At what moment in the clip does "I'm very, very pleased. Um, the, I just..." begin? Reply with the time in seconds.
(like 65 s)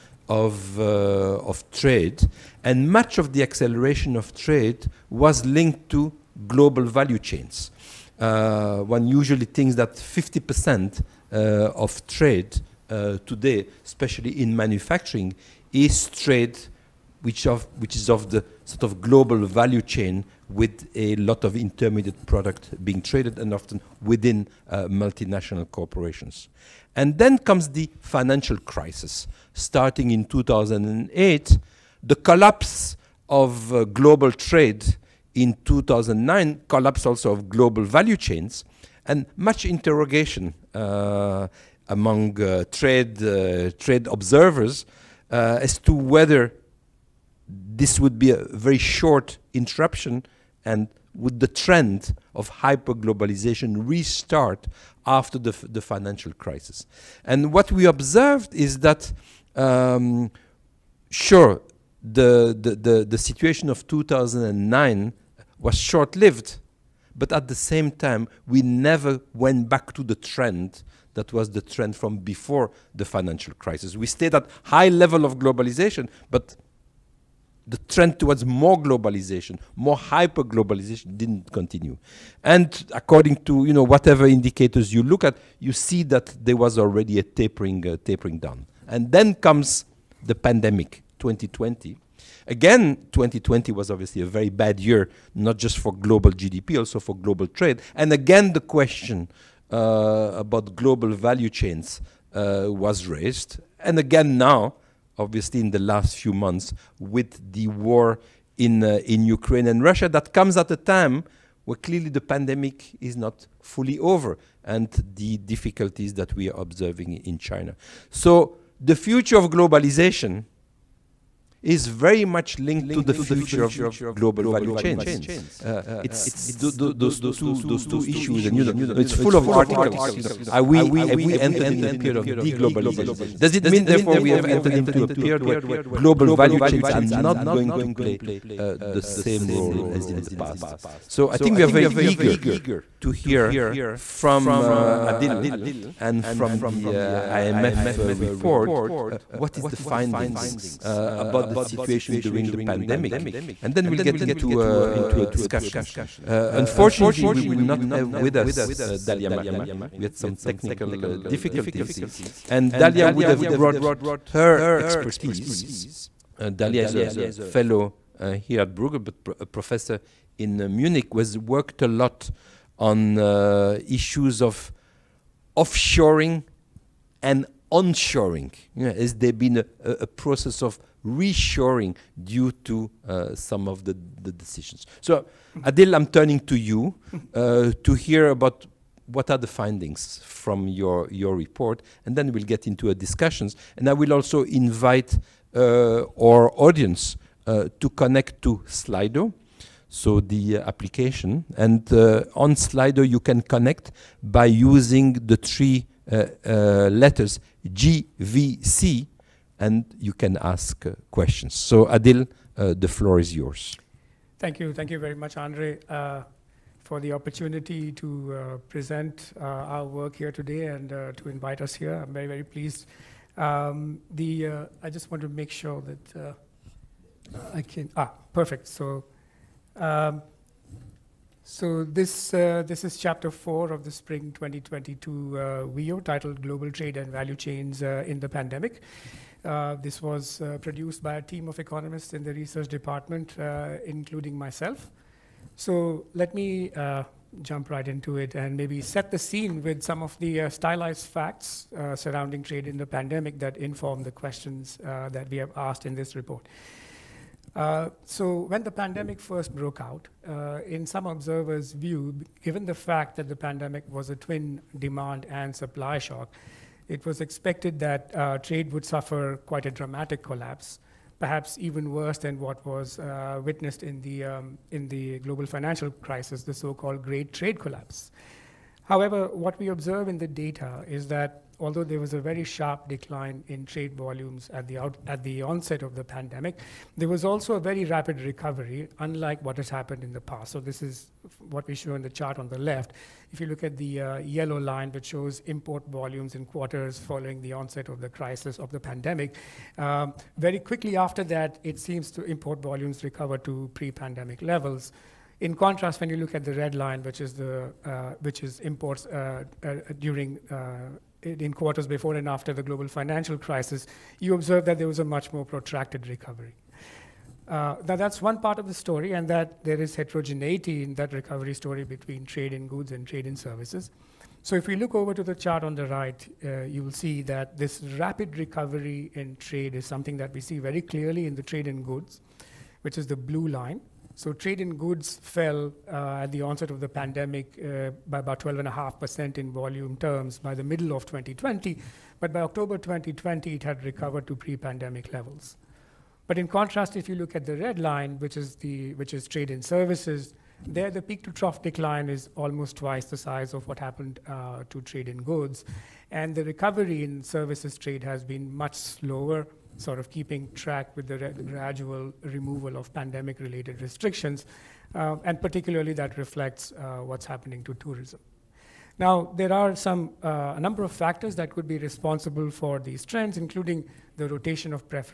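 221 s.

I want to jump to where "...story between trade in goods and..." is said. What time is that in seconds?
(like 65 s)
321 s.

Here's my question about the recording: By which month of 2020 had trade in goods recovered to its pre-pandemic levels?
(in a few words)
October.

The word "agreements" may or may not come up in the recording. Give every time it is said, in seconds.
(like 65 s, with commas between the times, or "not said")
not said.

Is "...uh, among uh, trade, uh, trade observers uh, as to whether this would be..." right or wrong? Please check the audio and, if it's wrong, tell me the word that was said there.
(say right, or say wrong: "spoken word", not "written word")
right.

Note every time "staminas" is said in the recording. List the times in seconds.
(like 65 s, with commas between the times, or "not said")
not said.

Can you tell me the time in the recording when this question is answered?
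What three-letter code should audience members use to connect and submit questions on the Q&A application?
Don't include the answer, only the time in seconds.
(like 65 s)
207 s.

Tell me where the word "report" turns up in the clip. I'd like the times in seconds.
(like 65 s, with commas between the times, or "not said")
148 s, 191 s, 256 s.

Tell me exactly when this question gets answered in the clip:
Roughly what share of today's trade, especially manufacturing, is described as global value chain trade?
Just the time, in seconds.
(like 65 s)
9 s.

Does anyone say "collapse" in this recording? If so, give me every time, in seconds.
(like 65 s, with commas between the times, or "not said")
32 s, 36 s, 270 s, 277 s.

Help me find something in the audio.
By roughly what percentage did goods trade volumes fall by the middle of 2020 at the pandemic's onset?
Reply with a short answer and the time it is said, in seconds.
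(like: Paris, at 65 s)
12.5%, at 338 s.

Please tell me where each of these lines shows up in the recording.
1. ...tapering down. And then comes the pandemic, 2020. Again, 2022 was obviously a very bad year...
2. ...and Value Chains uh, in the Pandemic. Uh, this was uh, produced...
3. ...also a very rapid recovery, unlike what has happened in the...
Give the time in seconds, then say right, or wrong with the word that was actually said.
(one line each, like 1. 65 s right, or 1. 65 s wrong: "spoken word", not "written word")
1. 88 s wrong: "2020", not "2022"
2. 236 s right
3. 287 s right.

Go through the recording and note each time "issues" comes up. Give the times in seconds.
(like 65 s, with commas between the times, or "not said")
128 s, 173 s.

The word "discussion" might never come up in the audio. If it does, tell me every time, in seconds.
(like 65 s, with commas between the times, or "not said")
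155 s, 192 s.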